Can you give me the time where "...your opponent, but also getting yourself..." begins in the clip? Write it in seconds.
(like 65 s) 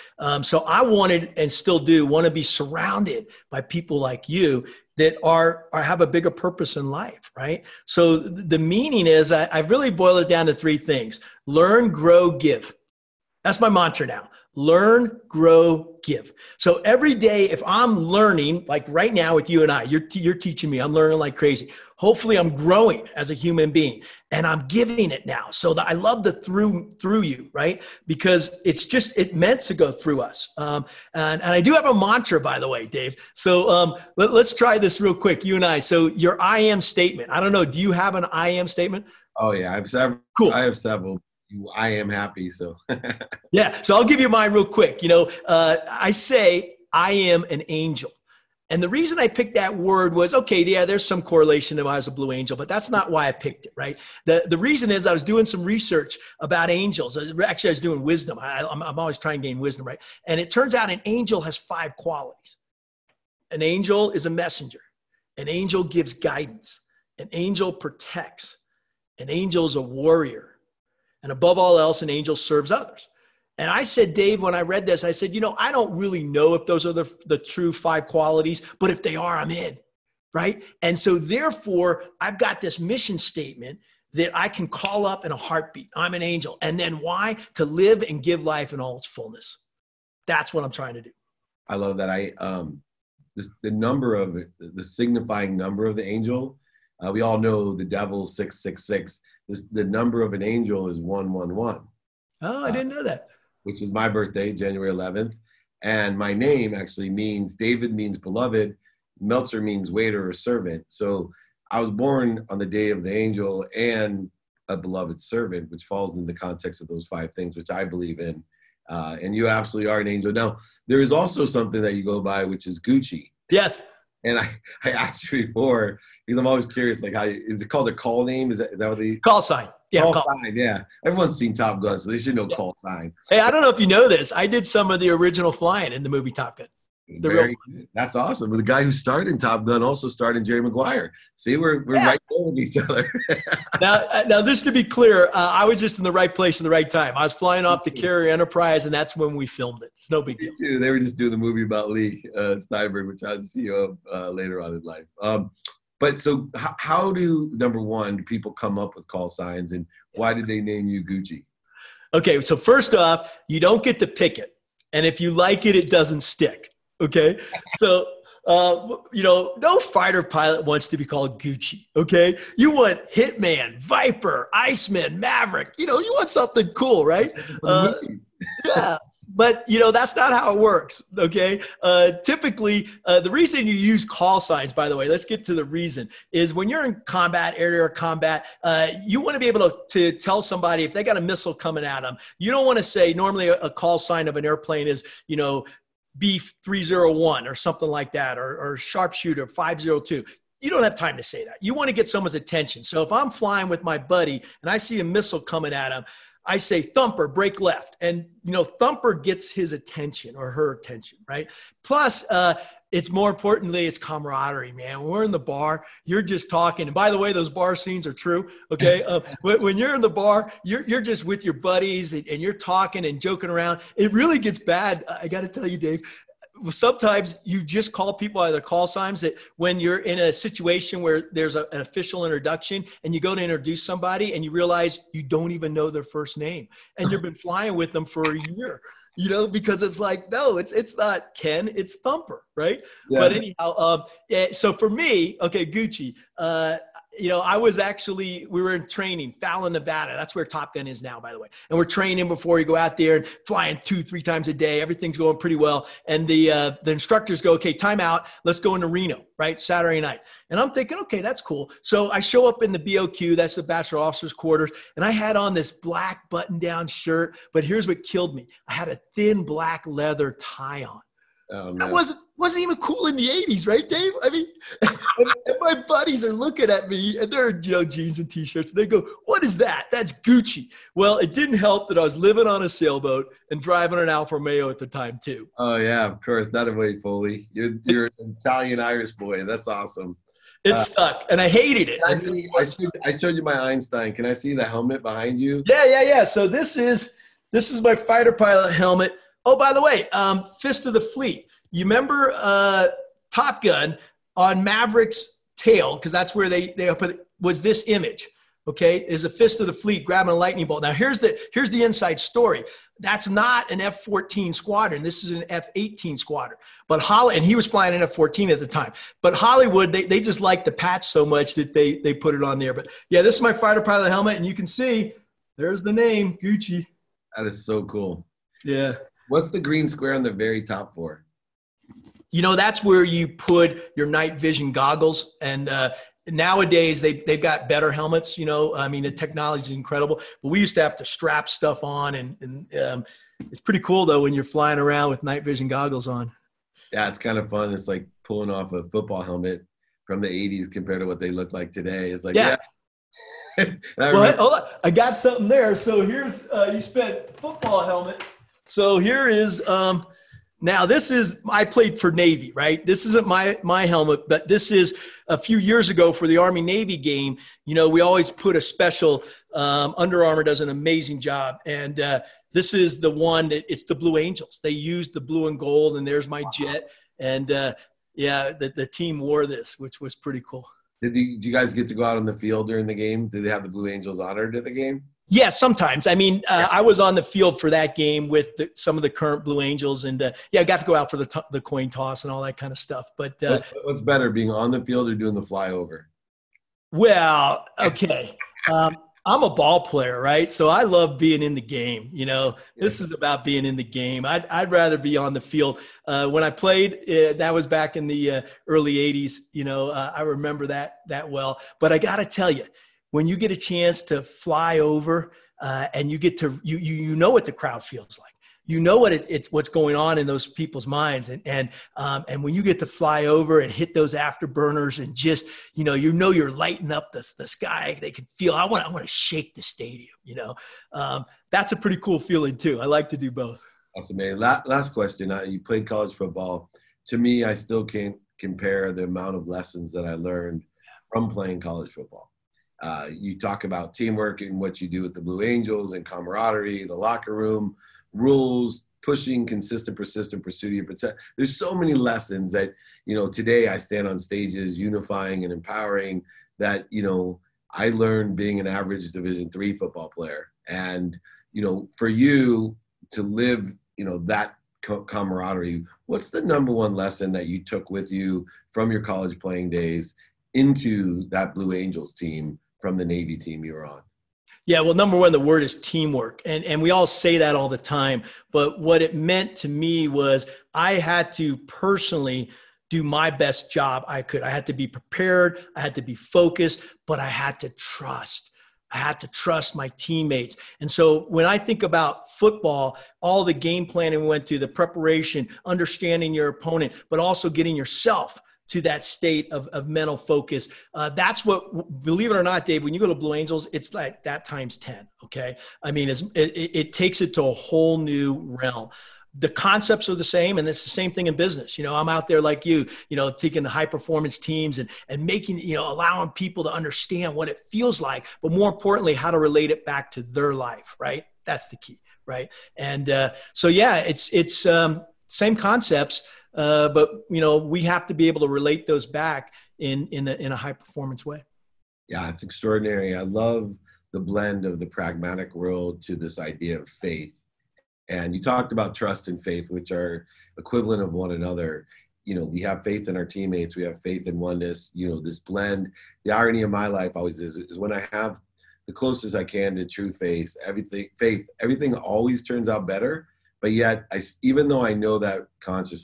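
496 s.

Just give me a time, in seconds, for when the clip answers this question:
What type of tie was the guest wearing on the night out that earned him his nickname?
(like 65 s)
269 s.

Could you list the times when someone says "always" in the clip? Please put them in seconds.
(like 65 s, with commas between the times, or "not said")
58 s, 126 s, 368 s, 547 s, 551 s.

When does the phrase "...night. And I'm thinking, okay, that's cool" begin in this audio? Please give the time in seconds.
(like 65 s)
260 s.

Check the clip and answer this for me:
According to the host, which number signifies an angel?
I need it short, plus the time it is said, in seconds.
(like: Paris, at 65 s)
111, at 100 s.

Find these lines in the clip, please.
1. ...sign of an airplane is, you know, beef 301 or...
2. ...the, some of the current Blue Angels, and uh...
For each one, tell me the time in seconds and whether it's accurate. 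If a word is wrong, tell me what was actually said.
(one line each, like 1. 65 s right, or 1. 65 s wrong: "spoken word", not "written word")
1. 193 s right
2. 388 s right.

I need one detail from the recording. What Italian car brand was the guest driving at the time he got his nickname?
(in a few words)
Alfa Romeo.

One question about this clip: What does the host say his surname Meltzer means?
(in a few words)
Waiter or servant.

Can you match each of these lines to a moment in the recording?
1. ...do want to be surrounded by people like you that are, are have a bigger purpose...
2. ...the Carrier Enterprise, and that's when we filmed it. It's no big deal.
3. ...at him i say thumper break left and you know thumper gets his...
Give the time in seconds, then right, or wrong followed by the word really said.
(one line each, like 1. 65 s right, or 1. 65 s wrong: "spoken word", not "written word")
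1. 1 s right
2. 147 s right
3. 205 s right.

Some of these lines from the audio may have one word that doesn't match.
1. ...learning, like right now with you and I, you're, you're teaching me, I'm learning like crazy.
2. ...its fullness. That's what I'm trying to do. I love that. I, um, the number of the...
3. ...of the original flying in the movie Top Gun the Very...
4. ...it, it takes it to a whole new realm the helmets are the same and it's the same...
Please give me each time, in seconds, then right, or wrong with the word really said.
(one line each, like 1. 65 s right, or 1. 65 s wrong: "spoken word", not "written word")
1. 17 s right
2. 88 s right
3. 134 s right
4. 506 s wrong: "concepts", not "helmets".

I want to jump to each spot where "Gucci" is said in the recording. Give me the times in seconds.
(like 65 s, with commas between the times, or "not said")
122 s, 161 s, 171 s, 245 s, 280 s, 326 s.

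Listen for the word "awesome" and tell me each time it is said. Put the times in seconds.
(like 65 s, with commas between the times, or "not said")
138 s, 289 s.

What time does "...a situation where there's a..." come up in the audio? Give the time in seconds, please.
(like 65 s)
230 s.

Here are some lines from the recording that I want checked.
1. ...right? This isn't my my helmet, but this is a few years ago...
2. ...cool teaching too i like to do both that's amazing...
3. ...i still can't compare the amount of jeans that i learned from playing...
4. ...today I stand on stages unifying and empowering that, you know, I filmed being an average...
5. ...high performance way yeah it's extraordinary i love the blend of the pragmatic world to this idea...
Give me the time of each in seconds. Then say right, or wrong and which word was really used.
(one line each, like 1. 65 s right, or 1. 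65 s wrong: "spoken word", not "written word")
1. 362 s right
2. 431 s wrong: "feeling", not "teaching"
3. 437 s wrong: "lessons", not "jeans"
4. 453 s wrong: "learned", not "filmed"
5. 530 s right.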